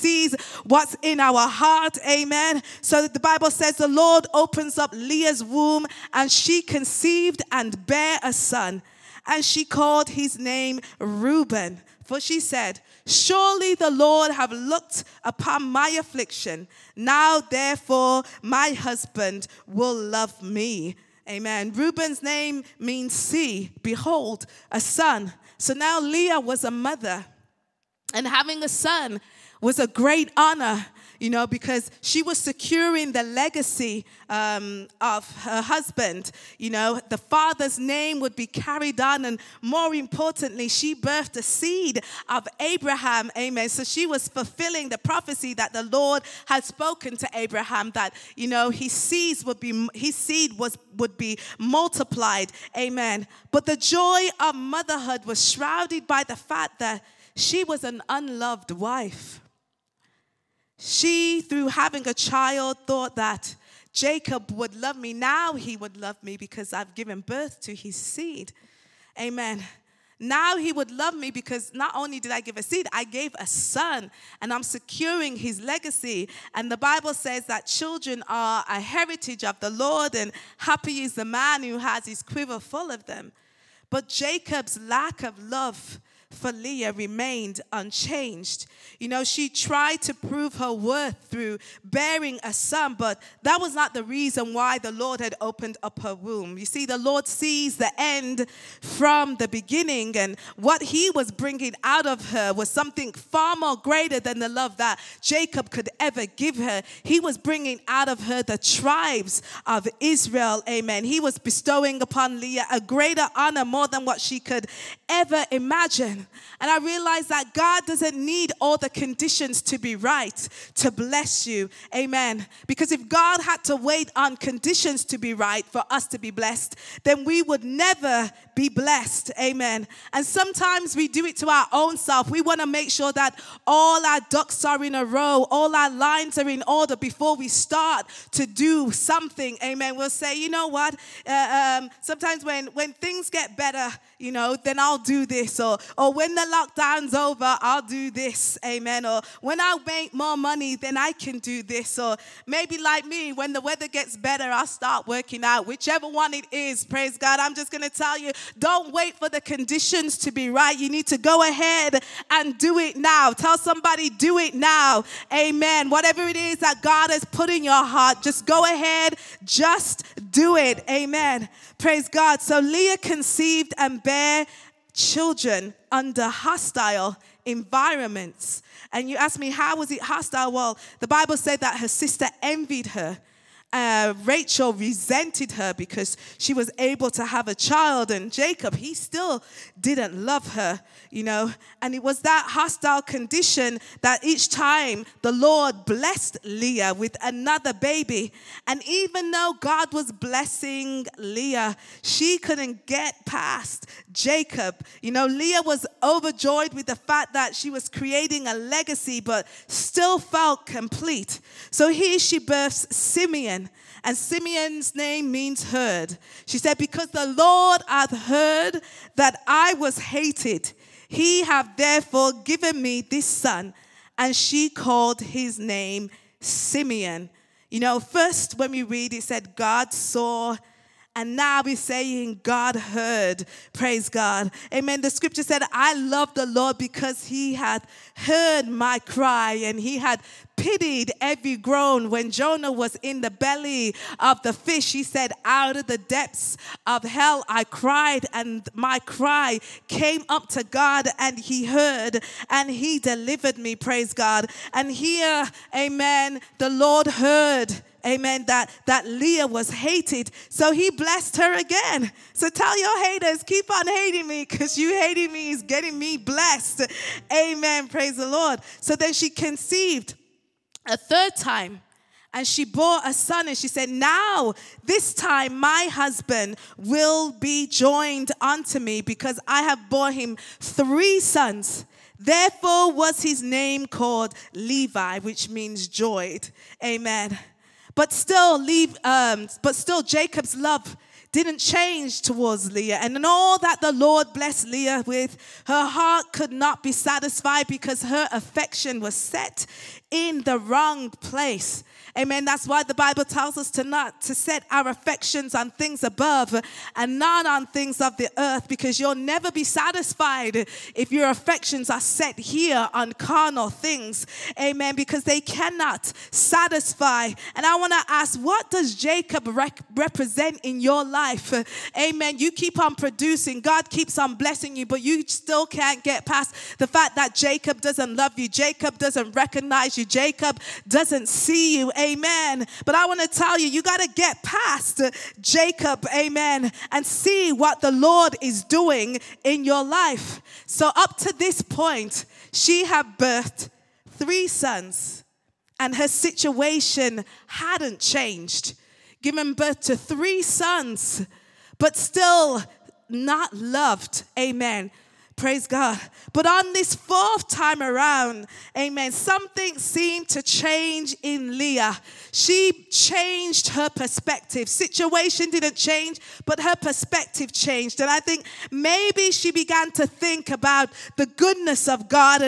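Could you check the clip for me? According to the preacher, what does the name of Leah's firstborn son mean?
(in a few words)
See, behold, a son.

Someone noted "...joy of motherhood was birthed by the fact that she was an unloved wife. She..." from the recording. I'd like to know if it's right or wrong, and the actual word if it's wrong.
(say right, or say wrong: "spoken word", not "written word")
wrong: "shrouded", not "birthed".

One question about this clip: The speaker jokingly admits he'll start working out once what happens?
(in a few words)
The weather gets better.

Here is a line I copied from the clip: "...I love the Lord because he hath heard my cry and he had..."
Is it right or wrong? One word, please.
right.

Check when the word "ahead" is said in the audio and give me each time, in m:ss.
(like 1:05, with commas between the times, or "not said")
2:41, 2:48.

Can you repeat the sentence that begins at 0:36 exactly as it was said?
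You know, the father's name would be carried on, and more importantly, she birthed a seed of Abraham.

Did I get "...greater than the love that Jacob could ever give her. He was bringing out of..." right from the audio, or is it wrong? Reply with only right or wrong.
right.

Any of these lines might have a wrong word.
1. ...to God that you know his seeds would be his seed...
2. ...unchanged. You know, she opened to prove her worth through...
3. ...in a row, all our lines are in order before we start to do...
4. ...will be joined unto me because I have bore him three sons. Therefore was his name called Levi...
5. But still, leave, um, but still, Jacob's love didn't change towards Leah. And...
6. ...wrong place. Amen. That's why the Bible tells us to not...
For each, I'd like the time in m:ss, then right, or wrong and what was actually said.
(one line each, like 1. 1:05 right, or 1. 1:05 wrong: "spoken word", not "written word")
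1. 0:47 wrong: "Abraham", not "God"
2. 1:27 wrong: "tried", not "opened"
3. 2:14 right
4. 4:36 right
5. 4:47 right
6. 5:00 right.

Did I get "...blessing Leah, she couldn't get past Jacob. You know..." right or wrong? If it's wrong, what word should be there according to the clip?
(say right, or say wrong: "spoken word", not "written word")
right.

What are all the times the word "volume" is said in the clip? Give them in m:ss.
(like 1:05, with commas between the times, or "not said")
not said.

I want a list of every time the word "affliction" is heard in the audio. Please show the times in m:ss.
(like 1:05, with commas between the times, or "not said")
0:15.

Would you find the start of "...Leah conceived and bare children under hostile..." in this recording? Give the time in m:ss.
2:52.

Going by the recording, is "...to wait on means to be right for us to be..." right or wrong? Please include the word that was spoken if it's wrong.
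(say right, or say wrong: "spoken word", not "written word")
wrong: "conditions", not "means".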